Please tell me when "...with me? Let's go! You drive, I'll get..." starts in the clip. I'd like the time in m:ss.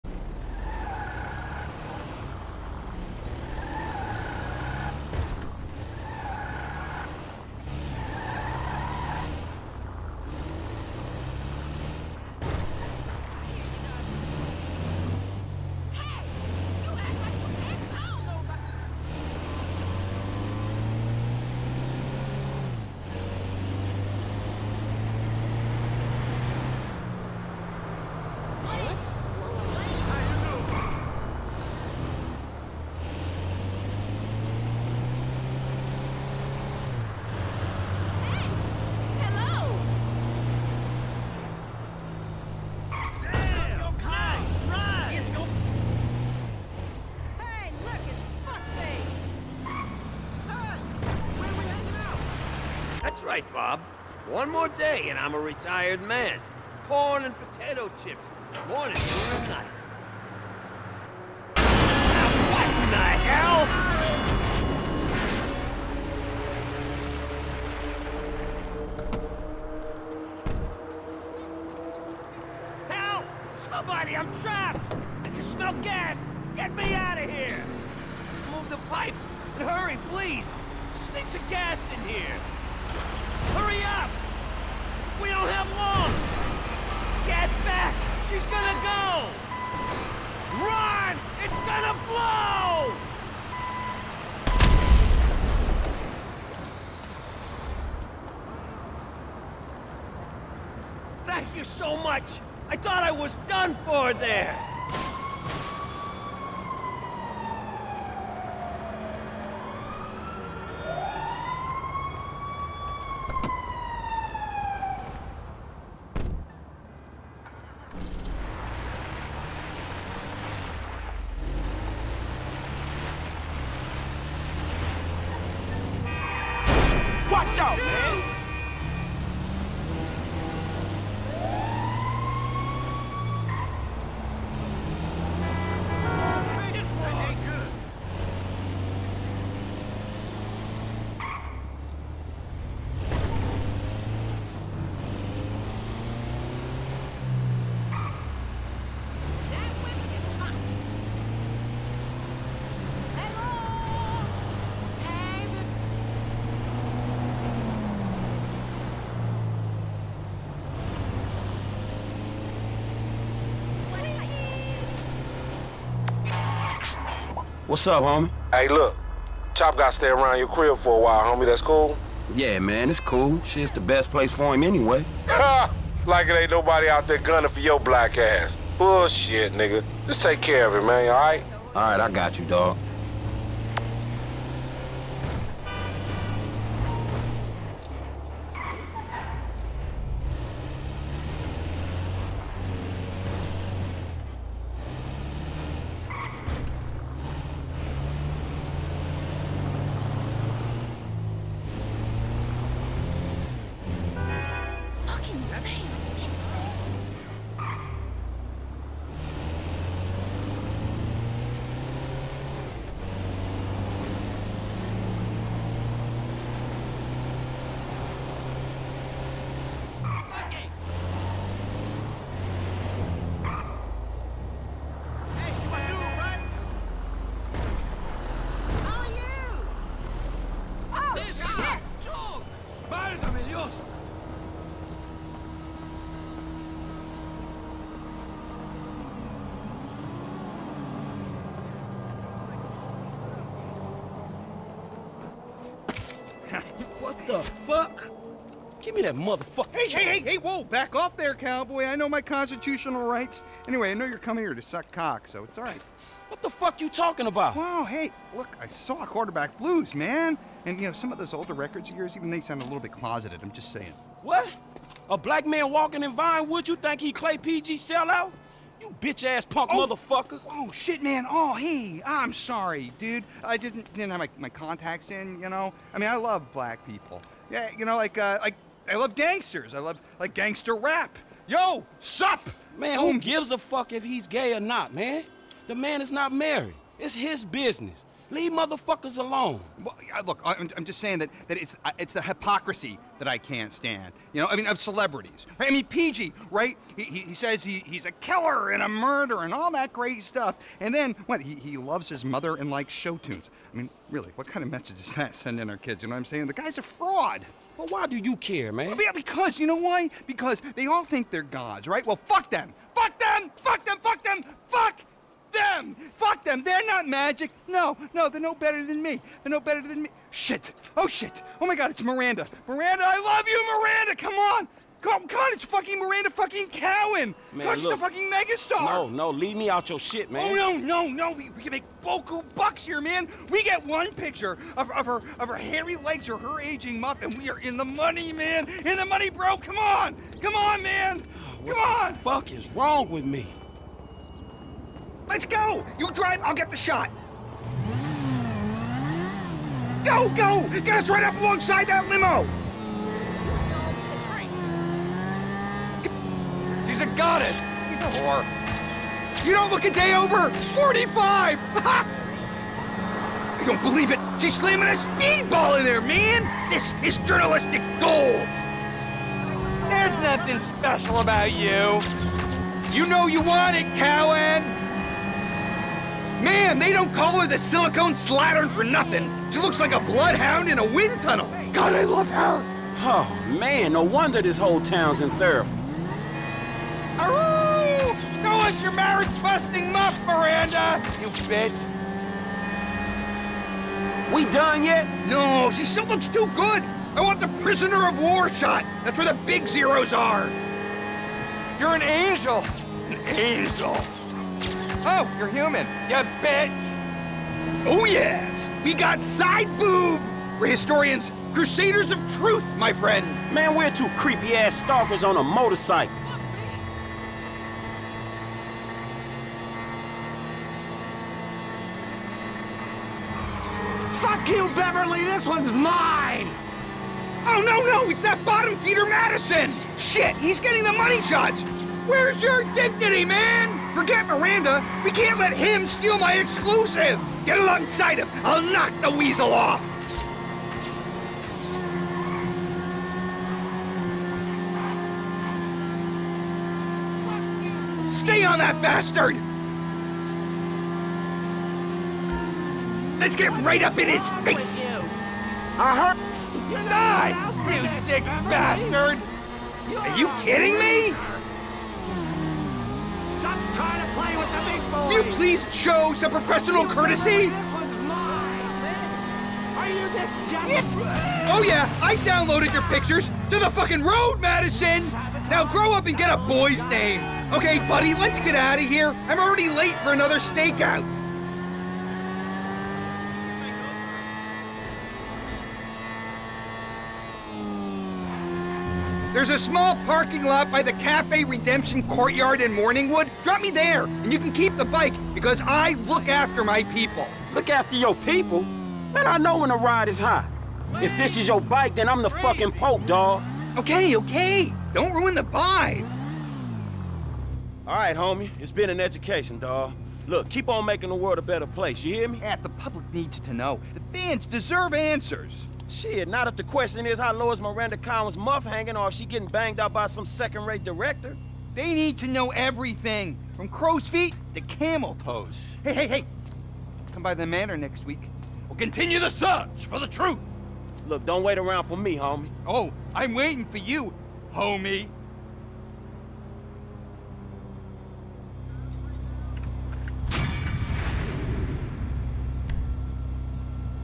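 5:43.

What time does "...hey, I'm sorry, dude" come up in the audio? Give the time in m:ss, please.
4:31.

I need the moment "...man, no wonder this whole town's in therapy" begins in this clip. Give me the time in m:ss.
6:23.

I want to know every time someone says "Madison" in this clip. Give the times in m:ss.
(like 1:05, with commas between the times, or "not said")
7:09, 7:54.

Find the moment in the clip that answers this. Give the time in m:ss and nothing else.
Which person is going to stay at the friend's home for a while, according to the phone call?
2:49.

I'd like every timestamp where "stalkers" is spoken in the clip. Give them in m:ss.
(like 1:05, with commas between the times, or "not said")
6:54.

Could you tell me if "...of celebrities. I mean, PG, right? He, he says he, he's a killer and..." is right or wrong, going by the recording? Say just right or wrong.
right.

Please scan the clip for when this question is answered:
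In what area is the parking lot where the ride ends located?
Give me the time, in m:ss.
8:12.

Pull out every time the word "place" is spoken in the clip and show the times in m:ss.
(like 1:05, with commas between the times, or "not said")
2:54, 8:31.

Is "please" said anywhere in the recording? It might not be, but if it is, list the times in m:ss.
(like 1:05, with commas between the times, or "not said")
1:20, 7:45.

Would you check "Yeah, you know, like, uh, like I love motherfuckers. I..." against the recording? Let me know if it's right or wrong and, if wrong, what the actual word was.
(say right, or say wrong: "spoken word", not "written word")
wrong: "gangsters", not "motherfuckers".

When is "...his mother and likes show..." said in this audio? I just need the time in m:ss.
5:02.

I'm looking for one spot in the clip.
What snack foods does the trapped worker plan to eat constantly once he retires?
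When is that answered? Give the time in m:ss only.
0:56.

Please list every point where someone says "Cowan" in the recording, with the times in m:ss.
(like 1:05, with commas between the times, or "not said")
5:26, 6:13.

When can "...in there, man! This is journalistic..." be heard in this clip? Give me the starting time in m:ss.
6:05.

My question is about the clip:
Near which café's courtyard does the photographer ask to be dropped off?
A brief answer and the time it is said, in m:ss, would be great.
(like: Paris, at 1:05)
Cafe Redemption, at 8:10.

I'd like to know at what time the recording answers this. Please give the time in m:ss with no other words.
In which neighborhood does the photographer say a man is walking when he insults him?
4:26.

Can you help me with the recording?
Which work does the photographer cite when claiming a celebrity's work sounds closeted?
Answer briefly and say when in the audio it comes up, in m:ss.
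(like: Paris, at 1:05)
Quarterback Blues, at 4:19.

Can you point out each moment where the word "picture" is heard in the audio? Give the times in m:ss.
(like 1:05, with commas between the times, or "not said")
5:34, 7:52.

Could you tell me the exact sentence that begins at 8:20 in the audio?
If this is your bike, then I'm the fucking Pope, dog.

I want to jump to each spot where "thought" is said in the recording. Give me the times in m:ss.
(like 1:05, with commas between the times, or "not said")
1:42.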